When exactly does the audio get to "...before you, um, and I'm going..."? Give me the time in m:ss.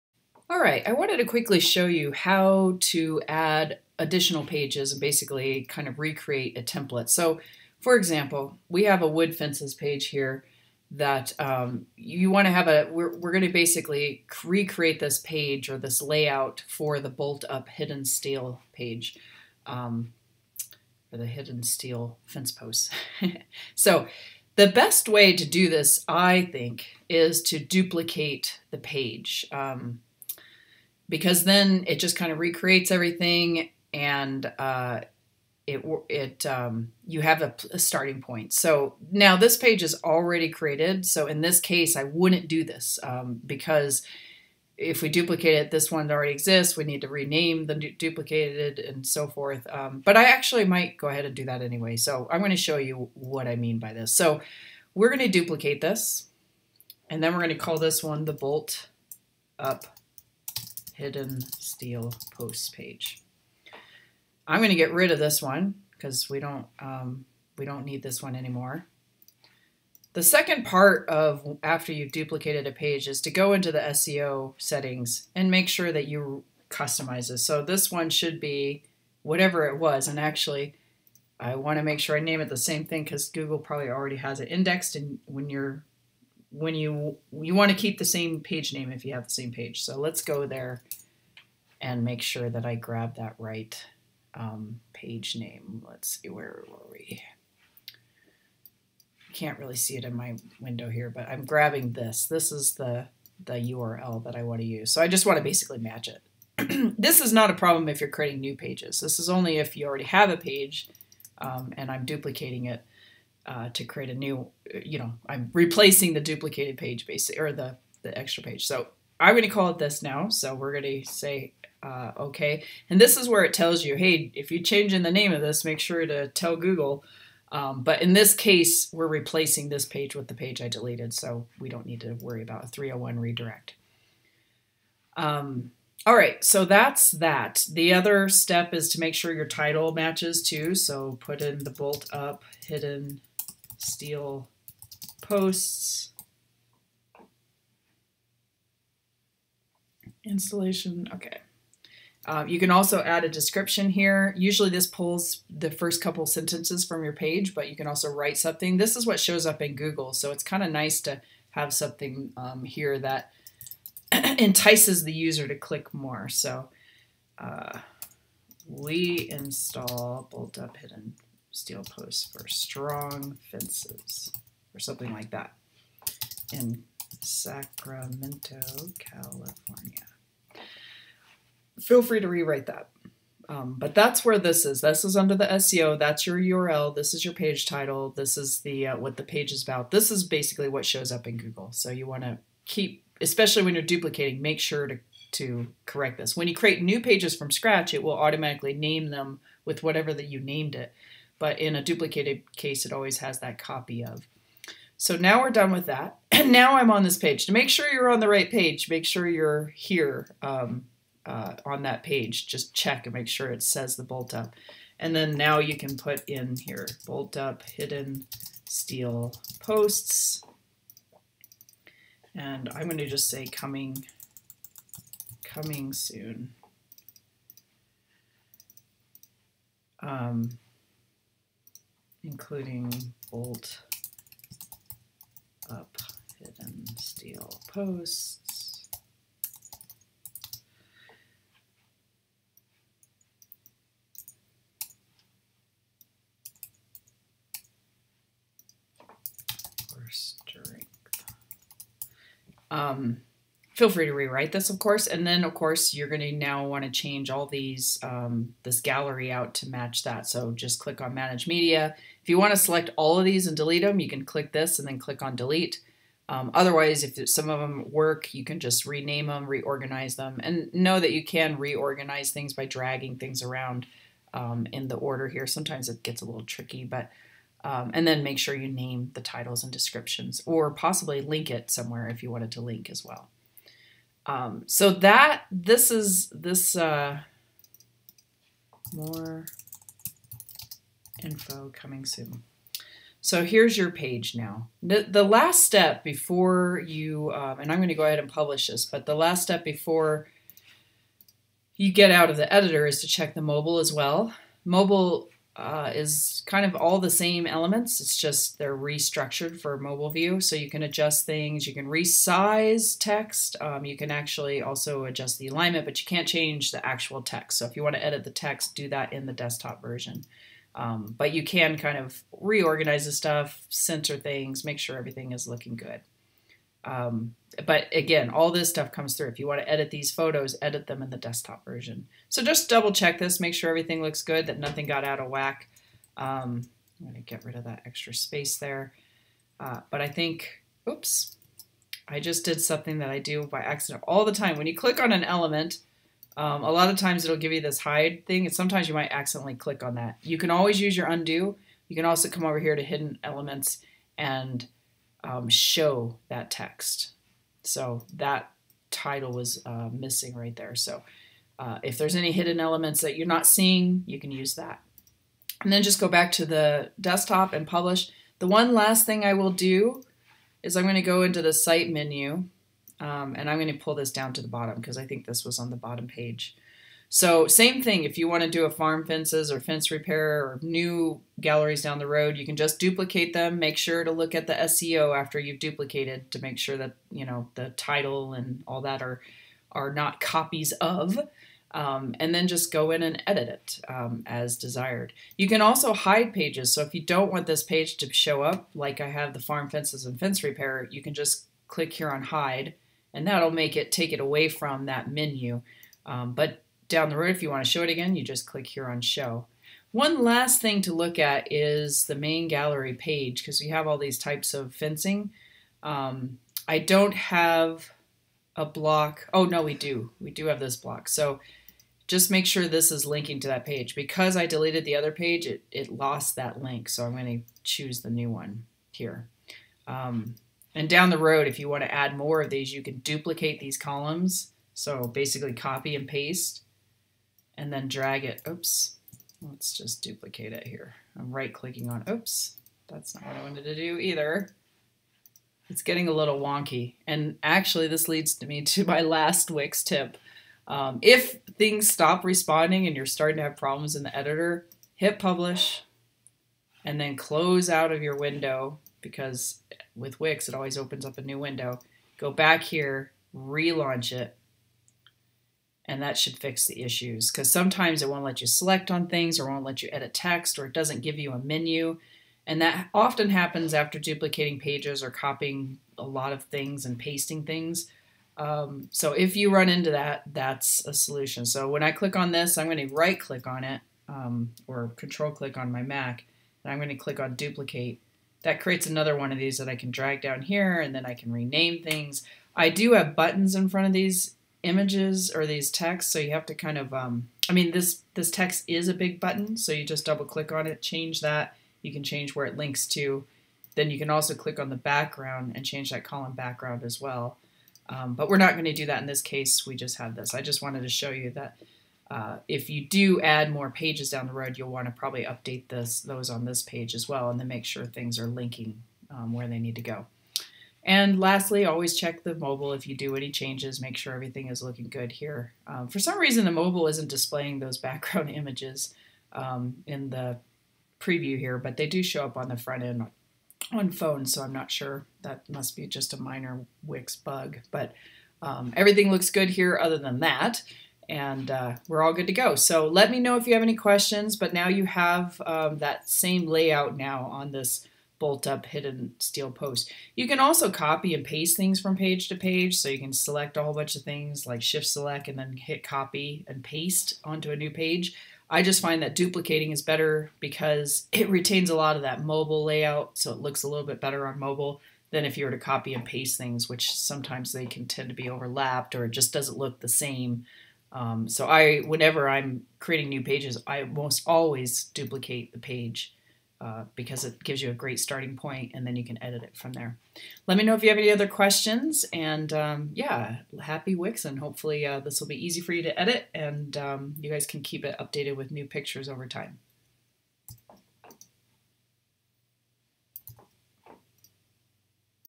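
4:56.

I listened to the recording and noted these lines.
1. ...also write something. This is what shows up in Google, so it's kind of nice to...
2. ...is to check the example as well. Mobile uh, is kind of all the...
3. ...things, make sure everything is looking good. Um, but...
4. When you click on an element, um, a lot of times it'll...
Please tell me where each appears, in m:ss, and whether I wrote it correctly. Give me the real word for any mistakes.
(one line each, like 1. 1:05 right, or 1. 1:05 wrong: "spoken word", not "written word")
1. 2:37 right
2. 5:02 wrong: "mobile", not "example"
3. 5:24 right
4. 5:44 right.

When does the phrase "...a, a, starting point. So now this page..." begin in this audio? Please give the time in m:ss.
0:37.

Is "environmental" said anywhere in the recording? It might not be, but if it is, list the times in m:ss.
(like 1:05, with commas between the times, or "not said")
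not said.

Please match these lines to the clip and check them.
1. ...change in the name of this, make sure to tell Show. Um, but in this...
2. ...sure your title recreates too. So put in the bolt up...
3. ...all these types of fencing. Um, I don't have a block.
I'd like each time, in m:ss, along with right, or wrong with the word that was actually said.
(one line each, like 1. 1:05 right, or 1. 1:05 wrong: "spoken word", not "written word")
1. 2:04 wrong: "Google", not "Show"
2. 2:19 wrong: "matches", not "recreates"
3. 6:53 right.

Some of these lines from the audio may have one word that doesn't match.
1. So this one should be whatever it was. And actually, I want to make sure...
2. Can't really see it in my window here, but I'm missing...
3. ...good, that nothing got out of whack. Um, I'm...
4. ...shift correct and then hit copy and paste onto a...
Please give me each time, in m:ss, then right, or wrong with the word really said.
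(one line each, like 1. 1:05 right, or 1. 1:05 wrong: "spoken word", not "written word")
1. 1:17 right
2. 1:39 wrong: "grabbing", not "missing"
3. 5:34 right
4. 9:14 wrong: "select", not "correct".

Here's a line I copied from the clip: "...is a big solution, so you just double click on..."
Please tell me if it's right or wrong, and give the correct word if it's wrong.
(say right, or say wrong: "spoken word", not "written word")
wrong: "button", not "solution".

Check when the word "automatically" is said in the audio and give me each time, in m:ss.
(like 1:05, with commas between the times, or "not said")
3:18.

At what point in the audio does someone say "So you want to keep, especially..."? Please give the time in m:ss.
3:11.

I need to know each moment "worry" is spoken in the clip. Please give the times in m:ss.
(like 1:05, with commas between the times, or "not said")
2:12.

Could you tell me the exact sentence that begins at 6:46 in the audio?
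Um, but down the road, if you want to show it again, you just click here on Show.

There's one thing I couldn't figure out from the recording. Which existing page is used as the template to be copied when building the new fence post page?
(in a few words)
Wood fences.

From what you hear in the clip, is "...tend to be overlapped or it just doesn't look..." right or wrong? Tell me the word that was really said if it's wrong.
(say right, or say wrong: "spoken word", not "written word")
right.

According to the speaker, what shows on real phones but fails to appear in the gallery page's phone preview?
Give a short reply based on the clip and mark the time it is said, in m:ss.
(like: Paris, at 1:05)
Background images, at 8:47.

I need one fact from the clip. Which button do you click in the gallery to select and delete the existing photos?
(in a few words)
Manage Media.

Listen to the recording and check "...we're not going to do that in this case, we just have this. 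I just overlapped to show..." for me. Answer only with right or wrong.
wrong.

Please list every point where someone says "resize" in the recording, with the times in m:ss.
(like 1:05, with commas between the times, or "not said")
5:11.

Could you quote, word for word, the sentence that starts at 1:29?
So let's go there and make sure that I grab that right um, page name.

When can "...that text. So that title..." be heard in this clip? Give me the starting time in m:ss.
5:56.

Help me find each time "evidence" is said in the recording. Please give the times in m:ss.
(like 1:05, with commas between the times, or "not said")
not said.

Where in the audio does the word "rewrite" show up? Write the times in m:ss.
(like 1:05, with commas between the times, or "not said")
3:02, 4:14.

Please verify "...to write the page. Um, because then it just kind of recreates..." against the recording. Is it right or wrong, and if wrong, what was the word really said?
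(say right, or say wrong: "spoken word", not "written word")
wrong: "duplicate", not "write".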